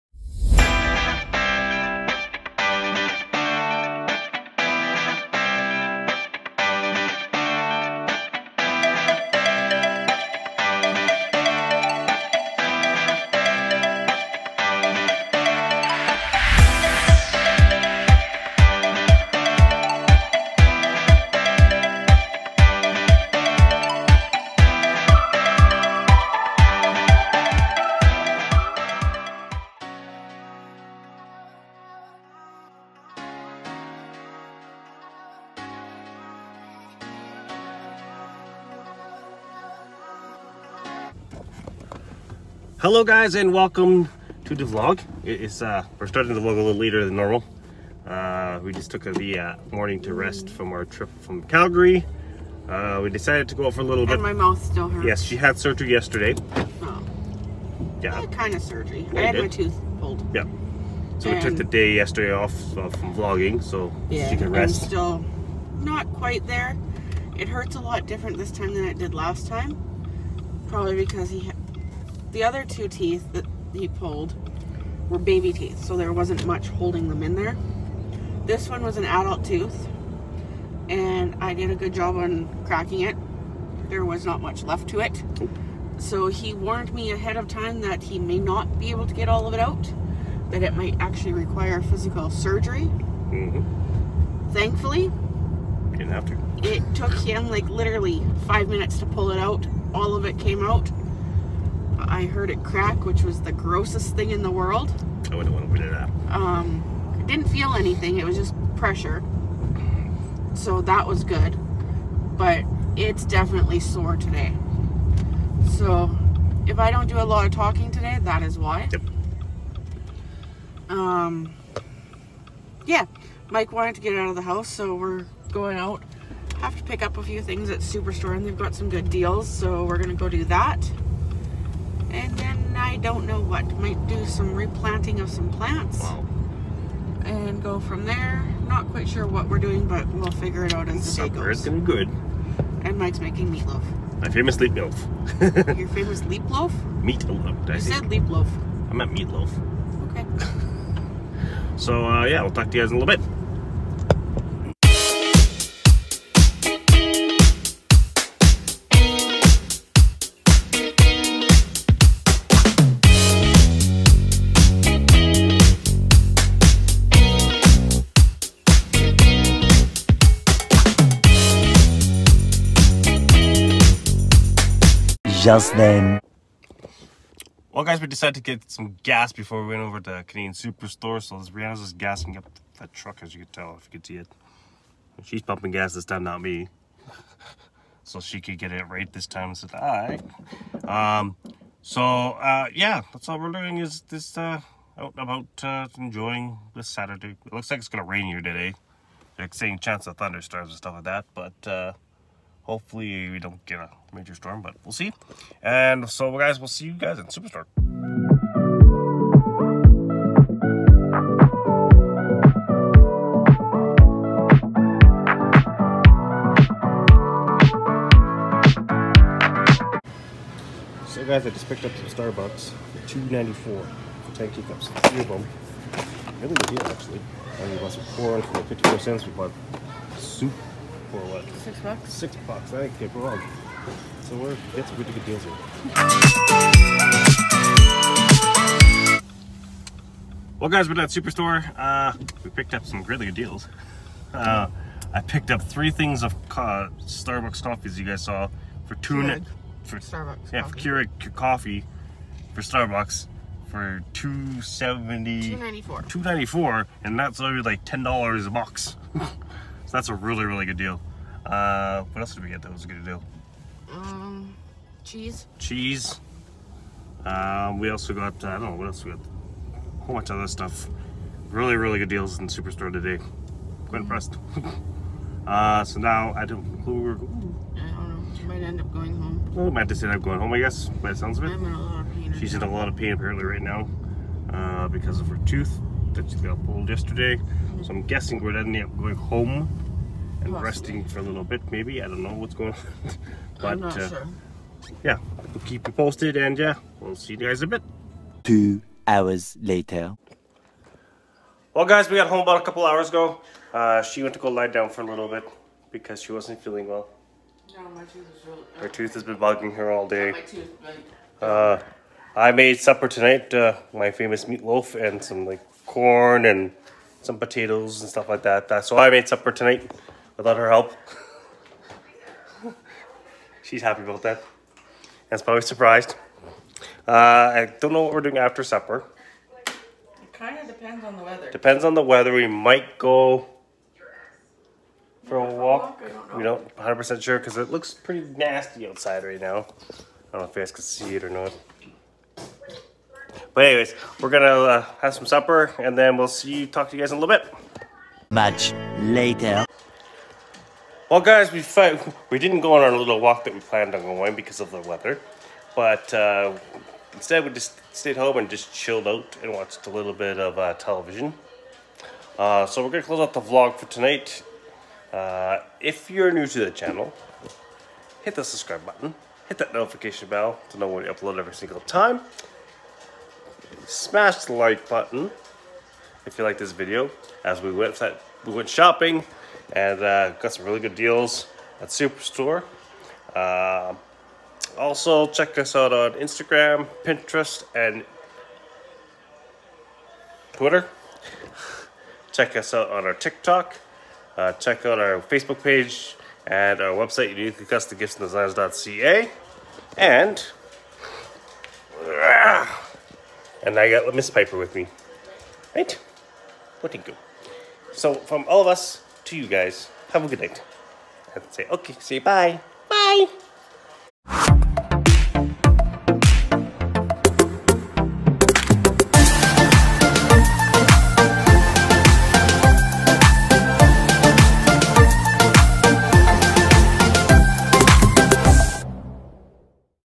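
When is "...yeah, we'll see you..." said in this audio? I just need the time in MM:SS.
04:56.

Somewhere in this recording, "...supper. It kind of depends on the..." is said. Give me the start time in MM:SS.
05:28.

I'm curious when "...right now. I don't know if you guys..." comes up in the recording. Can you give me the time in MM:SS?
05:39.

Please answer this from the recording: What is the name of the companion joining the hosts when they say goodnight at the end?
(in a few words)
Piper.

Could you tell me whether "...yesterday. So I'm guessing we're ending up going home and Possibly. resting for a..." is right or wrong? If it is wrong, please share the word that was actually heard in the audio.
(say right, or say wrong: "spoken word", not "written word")
right.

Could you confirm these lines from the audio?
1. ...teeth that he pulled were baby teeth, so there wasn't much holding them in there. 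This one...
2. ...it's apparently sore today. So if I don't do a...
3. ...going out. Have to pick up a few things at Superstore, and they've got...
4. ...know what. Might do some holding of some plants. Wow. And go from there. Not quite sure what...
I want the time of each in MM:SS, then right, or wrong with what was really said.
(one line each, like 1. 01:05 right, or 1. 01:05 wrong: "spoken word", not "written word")
1. 01:12 right
2. 01:52 wrong: "definitely", not "apparently"
3. 02:05 right
4. 02:13 wrong: "replanting", not "holding".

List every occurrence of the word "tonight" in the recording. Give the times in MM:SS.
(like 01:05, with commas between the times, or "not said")
05:13, 05:19, 06:03.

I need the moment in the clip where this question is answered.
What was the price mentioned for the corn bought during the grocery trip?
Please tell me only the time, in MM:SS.
03:48.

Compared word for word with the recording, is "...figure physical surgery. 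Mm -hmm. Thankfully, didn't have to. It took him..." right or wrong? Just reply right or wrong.
wrong.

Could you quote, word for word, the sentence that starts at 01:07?
It hurts a lot different this time than it did last time.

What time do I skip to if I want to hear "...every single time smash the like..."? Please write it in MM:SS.
06:11.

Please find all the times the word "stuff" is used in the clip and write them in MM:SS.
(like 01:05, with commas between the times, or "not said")
03:20, 04:30, 05:18.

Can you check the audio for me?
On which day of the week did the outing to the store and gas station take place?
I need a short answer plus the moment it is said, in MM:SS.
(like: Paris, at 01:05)
Saturday, at 03:16.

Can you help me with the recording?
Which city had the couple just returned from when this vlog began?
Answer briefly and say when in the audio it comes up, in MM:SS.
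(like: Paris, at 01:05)
Calgary, at 00:51.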